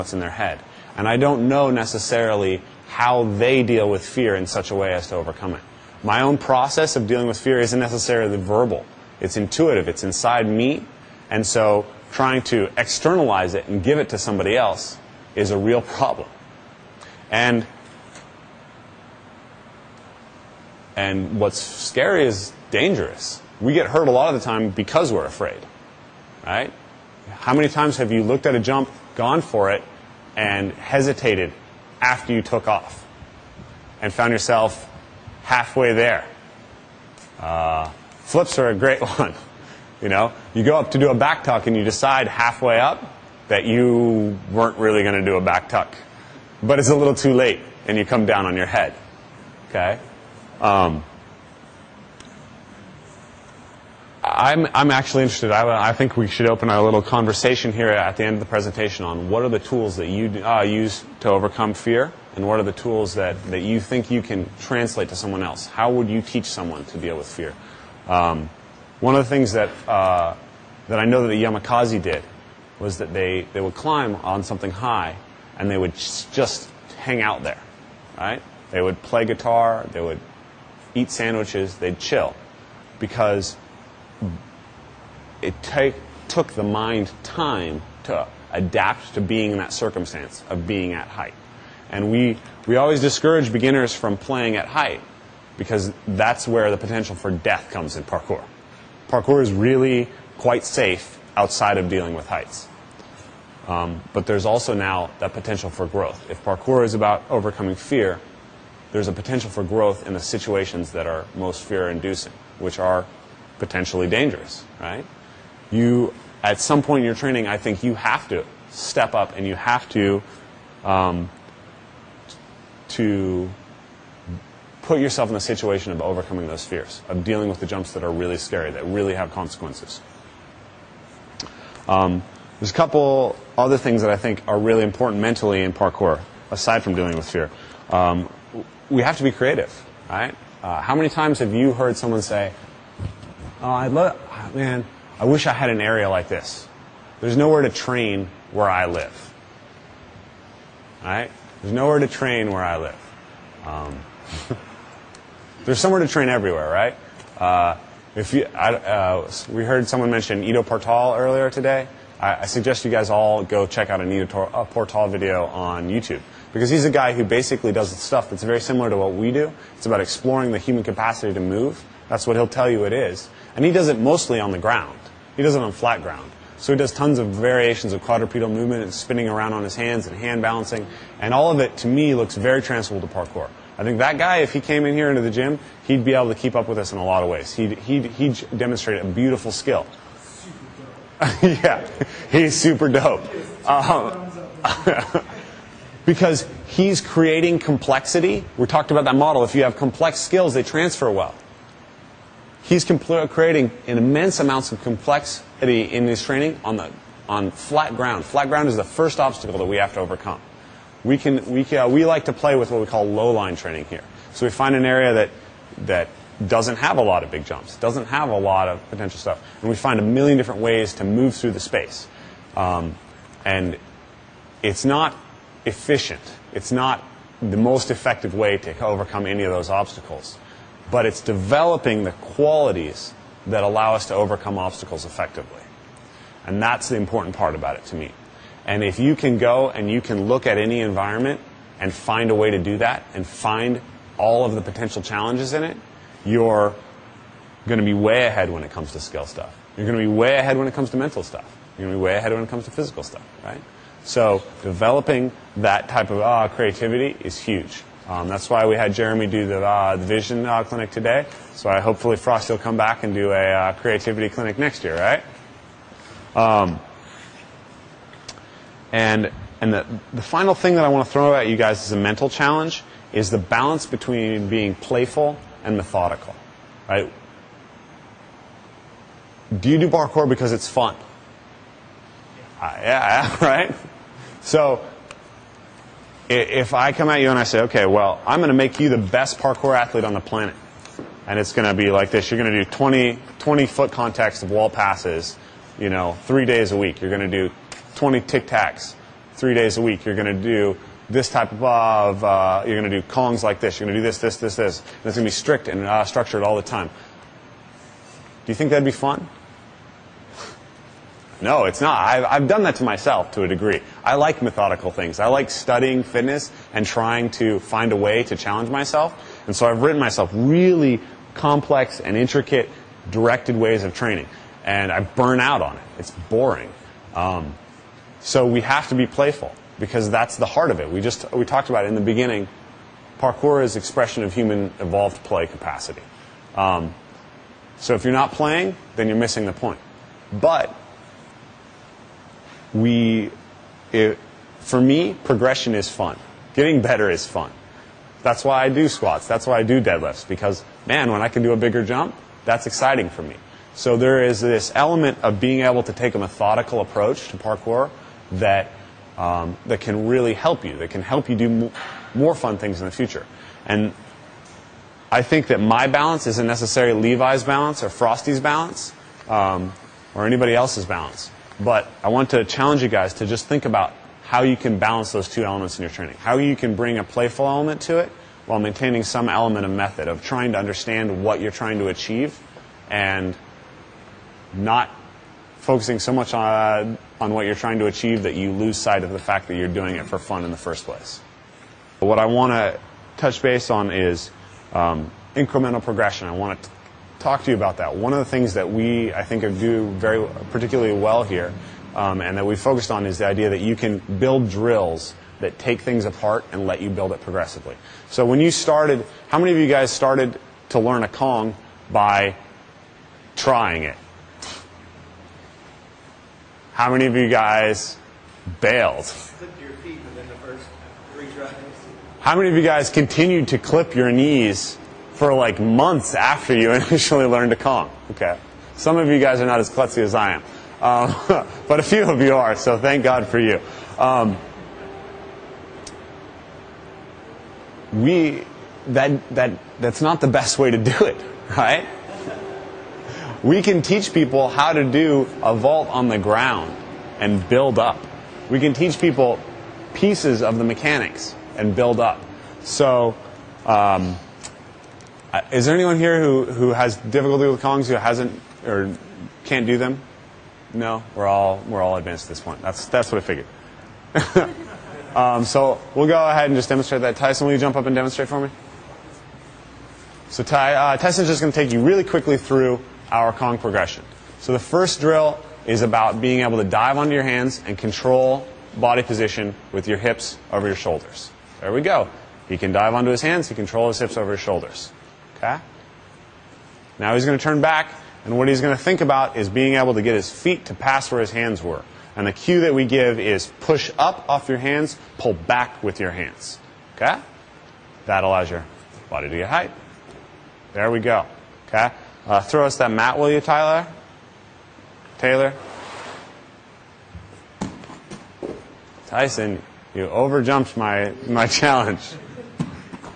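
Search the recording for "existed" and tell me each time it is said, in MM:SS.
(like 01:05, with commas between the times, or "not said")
not said.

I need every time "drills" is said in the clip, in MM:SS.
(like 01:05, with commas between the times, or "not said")
06:44, 07:54.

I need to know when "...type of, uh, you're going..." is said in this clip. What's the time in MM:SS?
05:01.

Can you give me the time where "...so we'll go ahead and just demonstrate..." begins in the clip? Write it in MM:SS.
07:45.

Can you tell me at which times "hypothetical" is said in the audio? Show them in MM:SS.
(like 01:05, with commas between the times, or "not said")
not said.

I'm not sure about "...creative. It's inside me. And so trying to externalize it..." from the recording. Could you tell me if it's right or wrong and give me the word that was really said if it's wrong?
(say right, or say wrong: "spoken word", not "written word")
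wrong: "intuitive", not "creative".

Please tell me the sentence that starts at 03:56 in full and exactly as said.
And that's the important part about it to me.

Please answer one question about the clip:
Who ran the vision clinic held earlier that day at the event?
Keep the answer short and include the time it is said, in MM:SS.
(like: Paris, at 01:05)
Jeremy, at 04:18.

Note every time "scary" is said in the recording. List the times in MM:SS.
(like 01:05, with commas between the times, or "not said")
00:21, 02:08.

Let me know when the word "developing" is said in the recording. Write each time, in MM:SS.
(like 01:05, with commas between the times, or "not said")
03:51, 04:14.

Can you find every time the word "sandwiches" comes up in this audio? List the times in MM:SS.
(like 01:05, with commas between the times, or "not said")
01:21.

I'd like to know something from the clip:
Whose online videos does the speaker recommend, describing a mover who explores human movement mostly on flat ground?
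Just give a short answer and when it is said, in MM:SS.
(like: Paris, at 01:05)
Ido Portal, at 02:40.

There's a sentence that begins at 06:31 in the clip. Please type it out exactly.
what I want to touch base on is um, incremental progression.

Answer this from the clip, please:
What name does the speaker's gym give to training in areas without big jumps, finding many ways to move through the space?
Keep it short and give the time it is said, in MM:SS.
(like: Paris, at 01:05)
low line training, at 03:33.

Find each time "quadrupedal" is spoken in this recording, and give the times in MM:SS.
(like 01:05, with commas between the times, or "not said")
02:58.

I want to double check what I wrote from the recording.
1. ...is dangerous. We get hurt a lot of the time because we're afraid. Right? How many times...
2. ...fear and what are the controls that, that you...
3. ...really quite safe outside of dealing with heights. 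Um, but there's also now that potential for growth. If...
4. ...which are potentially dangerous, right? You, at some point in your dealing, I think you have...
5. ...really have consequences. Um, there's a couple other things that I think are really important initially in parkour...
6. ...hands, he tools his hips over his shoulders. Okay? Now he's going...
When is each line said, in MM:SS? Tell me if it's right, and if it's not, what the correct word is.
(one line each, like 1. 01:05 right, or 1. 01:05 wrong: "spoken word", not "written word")
1. 00:22 right
2. 01:01 wrong: "tools", not "controls"
3. 01:39 right
4. 01:52 wrong: "training", not "dealing"
5. 02:08 wrong: "mentally", not "initially"
6. 08:03 wrong: "controls", not "tools".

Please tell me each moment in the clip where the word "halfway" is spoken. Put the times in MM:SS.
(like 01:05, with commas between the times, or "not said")
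00:35, 00:42.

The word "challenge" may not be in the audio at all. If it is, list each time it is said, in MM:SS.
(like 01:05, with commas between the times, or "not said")
04:05, 04:32, 05:18, 06:12, 08:31.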